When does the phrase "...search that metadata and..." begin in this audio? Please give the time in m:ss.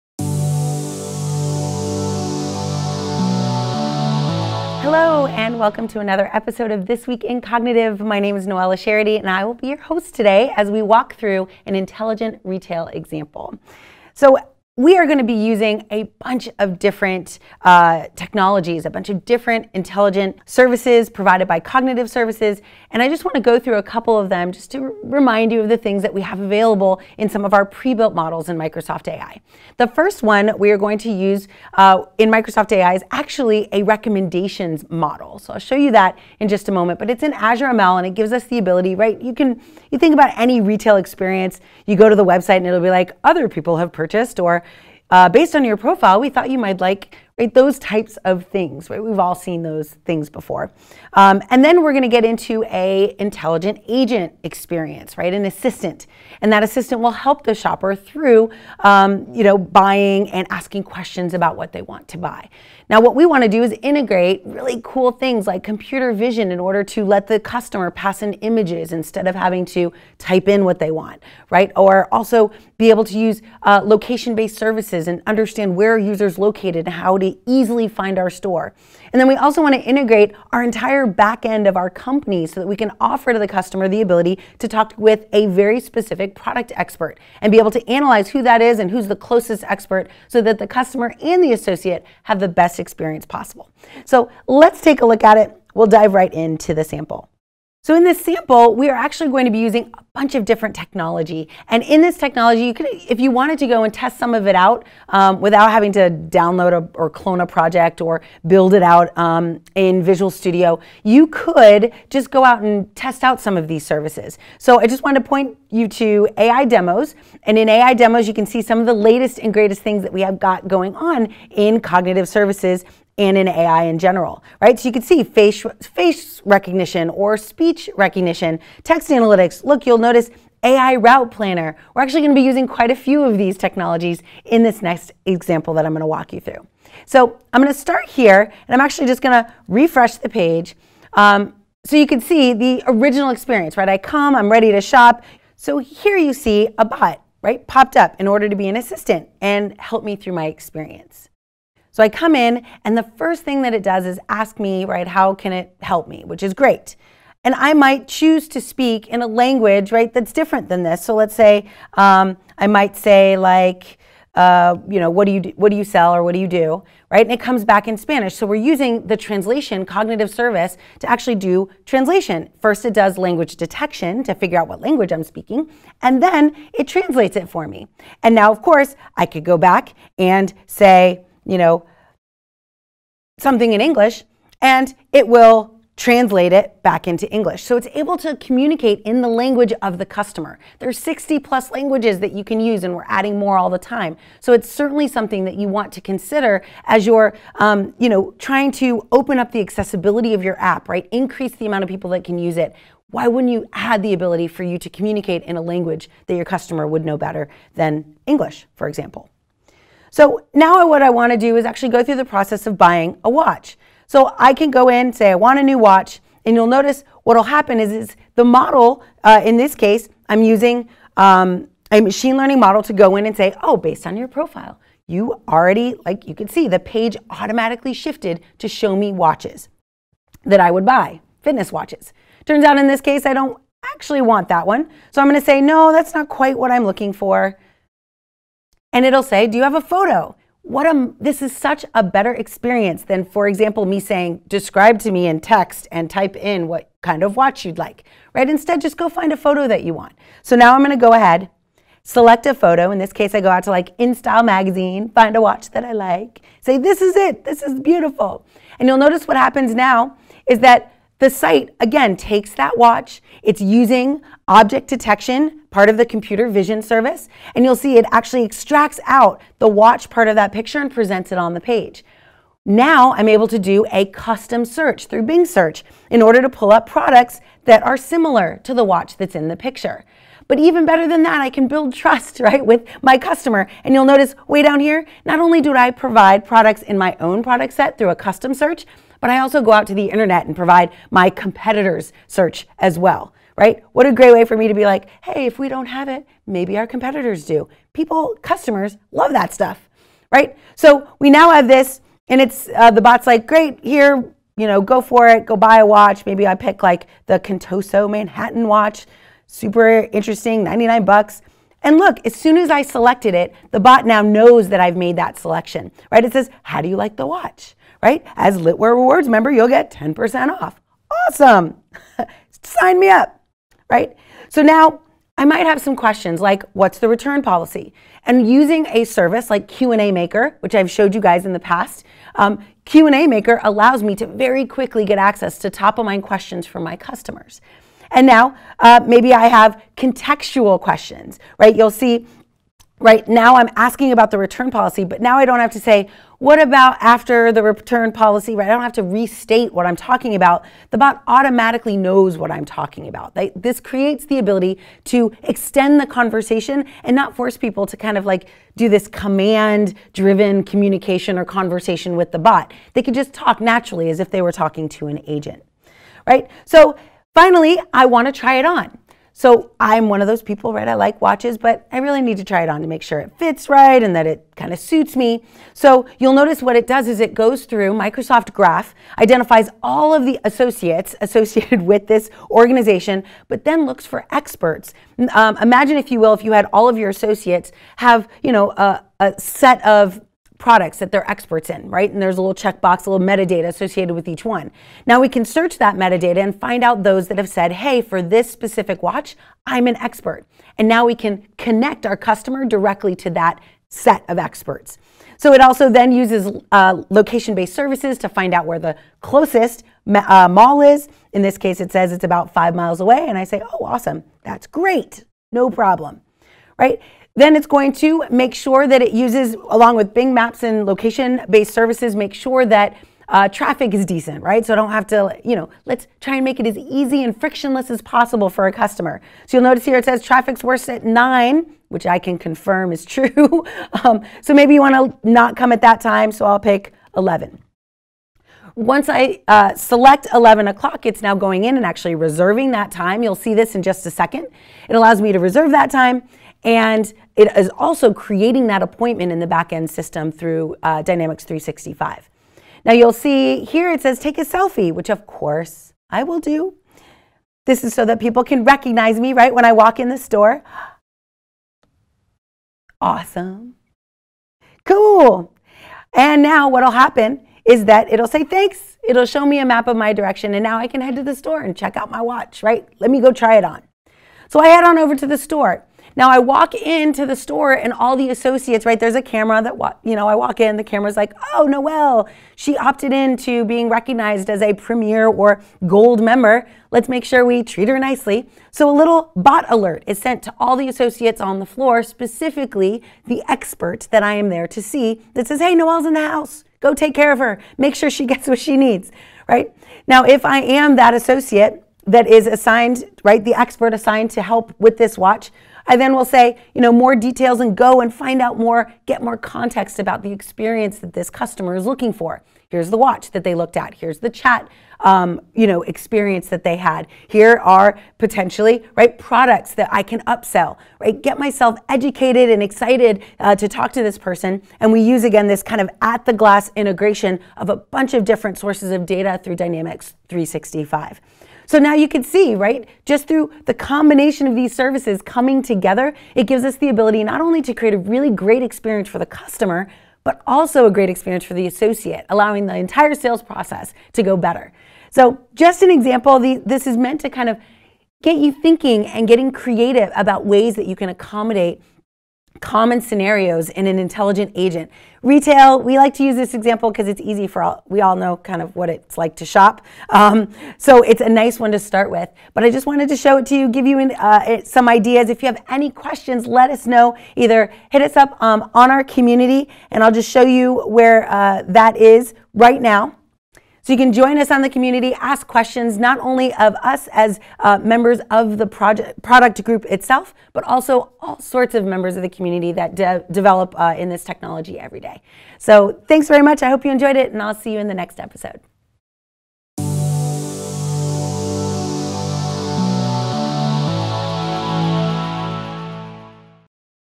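6:35.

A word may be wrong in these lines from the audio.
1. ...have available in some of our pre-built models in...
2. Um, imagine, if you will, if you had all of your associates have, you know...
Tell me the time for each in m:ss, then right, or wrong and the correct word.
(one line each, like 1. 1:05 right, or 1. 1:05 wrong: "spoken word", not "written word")
1. 0:26 right
2. 6:25 right.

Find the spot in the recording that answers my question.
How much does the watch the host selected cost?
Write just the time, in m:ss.
5:10.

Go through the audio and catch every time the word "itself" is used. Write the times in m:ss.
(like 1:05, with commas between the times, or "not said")
9:39.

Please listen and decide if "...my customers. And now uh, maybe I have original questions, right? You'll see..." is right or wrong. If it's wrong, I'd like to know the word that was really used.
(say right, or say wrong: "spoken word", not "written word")
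wrong: "contextual", not "original".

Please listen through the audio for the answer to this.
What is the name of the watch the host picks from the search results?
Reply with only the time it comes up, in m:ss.
5:07.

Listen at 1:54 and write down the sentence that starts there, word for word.
So I just wanted to point you to AI demos.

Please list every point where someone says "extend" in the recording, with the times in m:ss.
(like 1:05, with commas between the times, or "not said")
5:55.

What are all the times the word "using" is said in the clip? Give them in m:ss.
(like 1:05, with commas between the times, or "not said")
0:15, 1:39, 2:12, 2:48, 3:40, 4:23, 5:28.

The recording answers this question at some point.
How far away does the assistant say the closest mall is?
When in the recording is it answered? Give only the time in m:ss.
6:52.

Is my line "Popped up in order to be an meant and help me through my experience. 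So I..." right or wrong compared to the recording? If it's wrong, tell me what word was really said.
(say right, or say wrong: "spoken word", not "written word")
wrong: "assistant", not "meant".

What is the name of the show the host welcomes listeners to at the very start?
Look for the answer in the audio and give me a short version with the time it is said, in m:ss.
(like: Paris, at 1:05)
This Week in Cognitive, at 0:06.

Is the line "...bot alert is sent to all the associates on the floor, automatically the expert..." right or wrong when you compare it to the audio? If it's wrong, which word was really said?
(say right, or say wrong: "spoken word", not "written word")
wrong: "specifically", not "automatically".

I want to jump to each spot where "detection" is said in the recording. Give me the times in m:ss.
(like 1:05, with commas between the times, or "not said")
2:53, 4:24.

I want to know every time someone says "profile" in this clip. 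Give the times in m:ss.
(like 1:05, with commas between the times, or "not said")
0:45, 3:44.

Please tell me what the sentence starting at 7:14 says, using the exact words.
um, so maybe you want to not come at that time, so I'll pick 11.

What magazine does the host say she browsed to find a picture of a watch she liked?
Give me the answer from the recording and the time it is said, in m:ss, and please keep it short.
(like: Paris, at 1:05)
InStyle, at 4:13.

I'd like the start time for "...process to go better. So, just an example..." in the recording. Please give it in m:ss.
9:03.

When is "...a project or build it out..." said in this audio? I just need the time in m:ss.
1:47.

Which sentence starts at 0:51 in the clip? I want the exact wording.
Um, and then we're going to get into a intelligent agent experience, right?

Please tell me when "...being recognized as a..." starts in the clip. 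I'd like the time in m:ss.
8:03.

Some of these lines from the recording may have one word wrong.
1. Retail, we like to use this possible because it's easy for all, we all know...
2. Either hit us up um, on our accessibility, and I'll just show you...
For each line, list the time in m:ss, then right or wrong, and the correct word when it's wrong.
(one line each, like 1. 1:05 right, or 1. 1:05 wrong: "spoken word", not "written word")
1. 9:15 wrong: "example", not "possible"
2. 9:27 wrong: "community", not "accessibility".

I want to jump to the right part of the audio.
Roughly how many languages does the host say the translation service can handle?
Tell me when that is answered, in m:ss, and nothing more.
3:10.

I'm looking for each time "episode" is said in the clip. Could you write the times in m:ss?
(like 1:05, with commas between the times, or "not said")
0:06, 9:48.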